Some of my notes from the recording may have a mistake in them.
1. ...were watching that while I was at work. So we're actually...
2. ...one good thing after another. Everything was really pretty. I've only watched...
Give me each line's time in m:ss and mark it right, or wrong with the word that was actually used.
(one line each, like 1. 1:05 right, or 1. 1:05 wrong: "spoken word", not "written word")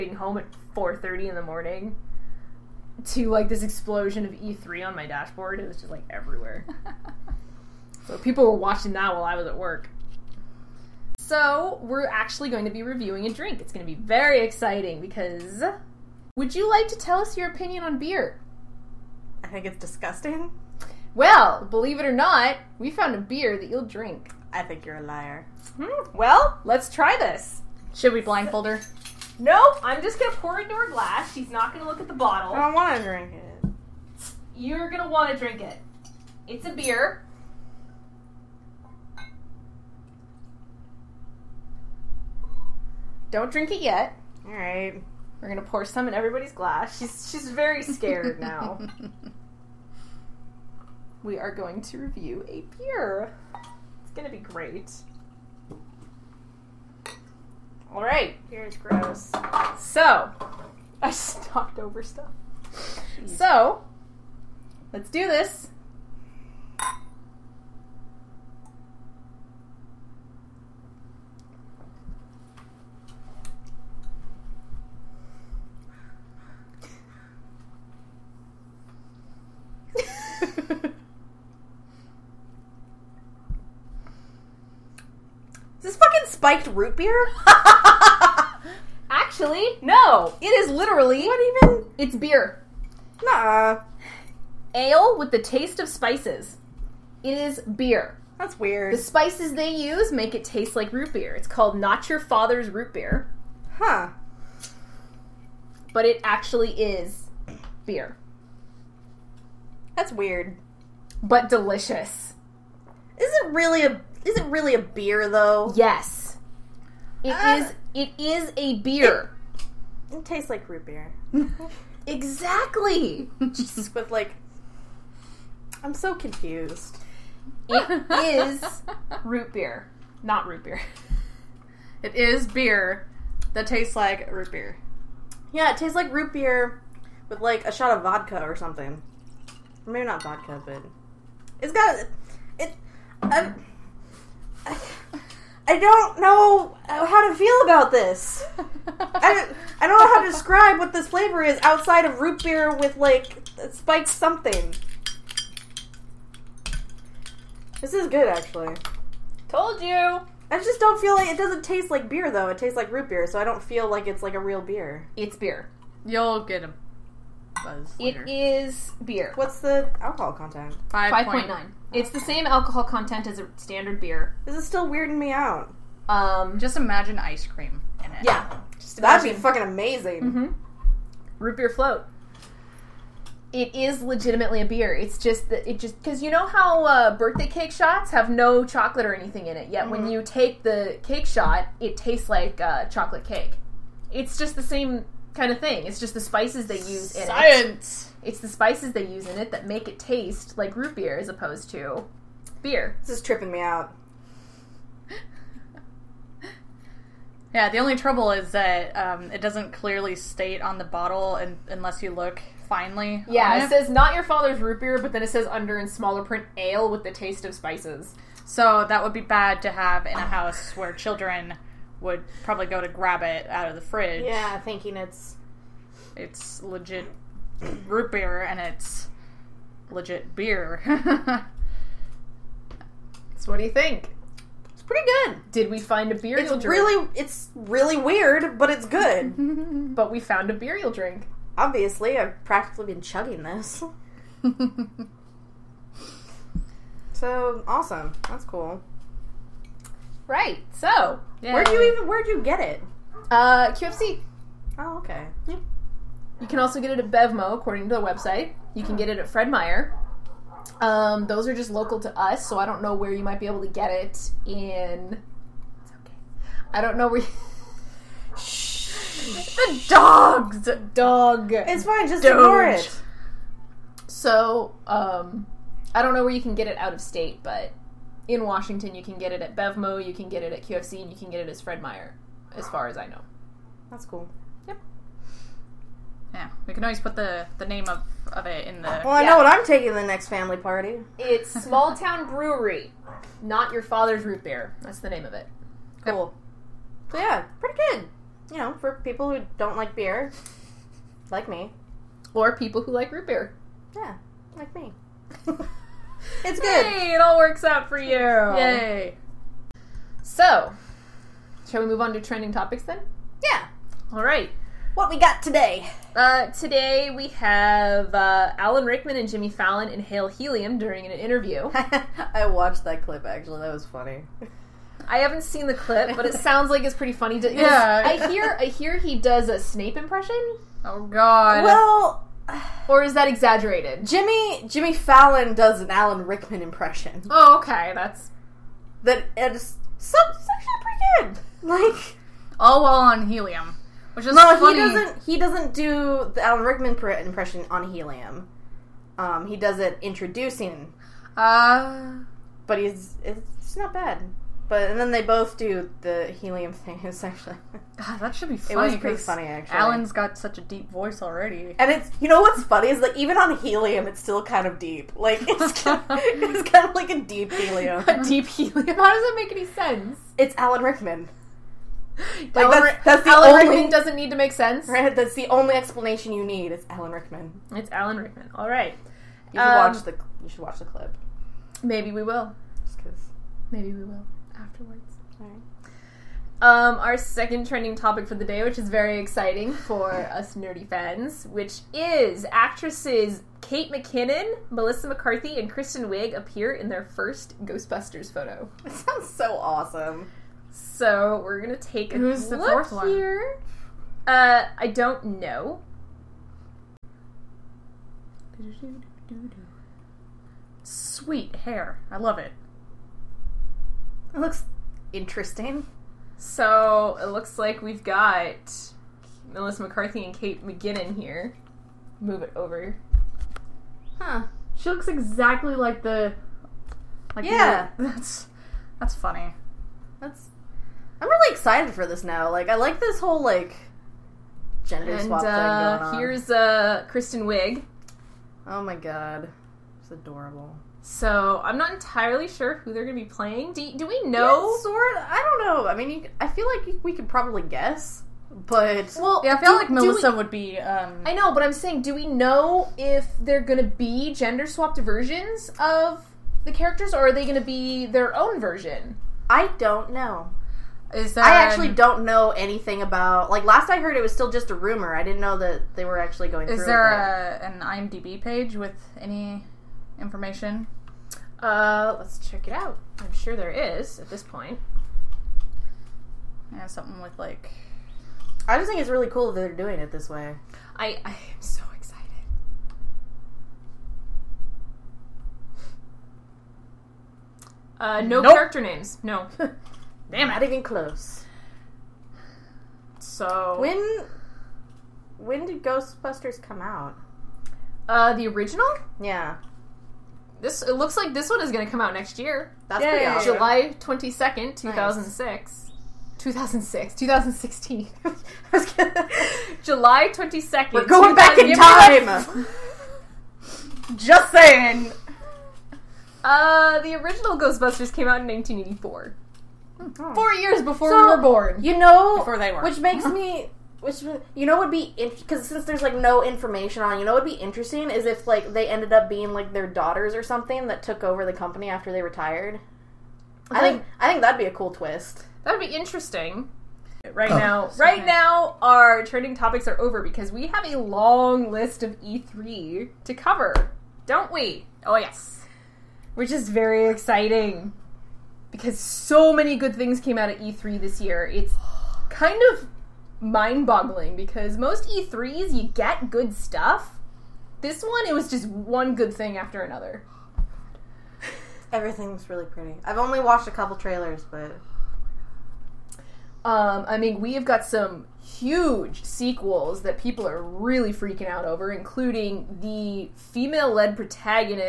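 1. 0:08 right
2. 9:18 right.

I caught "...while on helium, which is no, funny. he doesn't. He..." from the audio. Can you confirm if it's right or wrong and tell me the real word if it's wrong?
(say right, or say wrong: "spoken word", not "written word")
right.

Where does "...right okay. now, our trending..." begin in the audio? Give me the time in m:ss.
8:57.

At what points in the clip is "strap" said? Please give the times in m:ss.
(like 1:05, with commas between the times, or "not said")
not said.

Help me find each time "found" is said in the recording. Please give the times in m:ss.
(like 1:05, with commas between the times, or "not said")
0:22, 4:00.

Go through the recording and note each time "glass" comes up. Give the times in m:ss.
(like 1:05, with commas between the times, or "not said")
0:30, 0:46.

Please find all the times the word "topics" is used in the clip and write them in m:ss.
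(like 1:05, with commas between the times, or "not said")
5:12, 6:27, 8:59.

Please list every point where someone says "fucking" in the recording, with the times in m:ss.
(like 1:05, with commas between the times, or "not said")
2:59.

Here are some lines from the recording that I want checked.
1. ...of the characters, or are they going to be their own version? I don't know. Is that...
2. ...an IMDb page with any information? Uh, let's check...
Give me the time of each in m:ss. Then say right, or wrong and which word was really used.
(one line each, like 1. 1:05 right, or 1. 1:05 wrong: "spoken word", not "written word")
1. 7:35 right
2. 7:47 right.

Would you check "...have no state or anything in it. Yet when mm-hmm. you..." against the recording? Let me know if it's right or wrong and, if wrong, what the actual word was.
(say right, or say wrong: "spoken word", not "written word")
wrong: "chocolate", not "state".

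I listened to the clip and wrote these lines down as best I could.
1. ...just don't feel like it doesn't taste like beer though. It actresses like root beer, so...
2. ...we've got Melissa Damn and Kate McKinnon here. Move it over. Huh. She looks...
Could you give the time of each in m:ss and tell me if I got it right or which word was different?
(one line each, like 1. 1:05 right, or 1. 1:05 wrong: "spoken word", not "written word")
1. 2:40 wrong: "tastes", not "actresses"
2. 6:57 wrong: "McCarthy", not "Damn".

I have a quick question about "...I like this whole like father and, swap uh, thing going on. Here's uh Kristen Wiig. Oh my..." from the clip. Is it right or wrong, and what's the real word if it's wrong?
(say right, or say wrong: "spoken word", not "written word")
wrong: "gender", not "father".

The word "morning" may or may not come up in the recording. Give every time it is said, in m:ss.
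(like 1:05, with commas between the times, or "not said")
0:01.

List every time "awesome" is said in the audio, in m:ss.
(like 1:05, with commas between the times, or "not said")
4:07, 6:39, 8:23.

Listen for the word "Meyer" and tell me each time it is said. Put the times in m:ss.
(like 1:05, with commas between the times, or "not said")
4:19, 4:41.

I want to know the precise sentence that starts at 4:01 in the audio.
Obviously, I've practically been chugging this.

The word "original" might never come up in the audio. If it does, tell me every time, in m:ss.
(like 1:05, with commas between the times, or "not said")
8:18, 8:37.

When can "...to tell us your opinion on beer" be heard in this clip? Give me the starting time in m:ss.
0:16.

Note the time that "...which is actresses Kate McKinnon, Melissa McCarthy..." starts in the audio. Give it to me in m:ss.
6:31.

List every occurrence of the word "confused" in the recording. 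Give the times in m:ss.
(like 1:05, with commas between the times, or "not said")
2:06.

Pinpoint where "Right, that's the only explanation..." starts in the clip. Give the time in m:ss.
6:14.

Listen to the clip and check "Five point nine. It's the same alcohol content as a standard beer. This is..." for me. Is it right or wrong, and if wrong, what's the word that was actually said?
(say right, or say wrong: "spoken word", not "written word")
right.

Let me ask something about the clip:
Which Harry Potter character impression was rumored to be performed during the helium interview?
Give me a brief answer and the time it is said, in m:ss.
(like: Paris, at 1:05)
Snape, at 5:29.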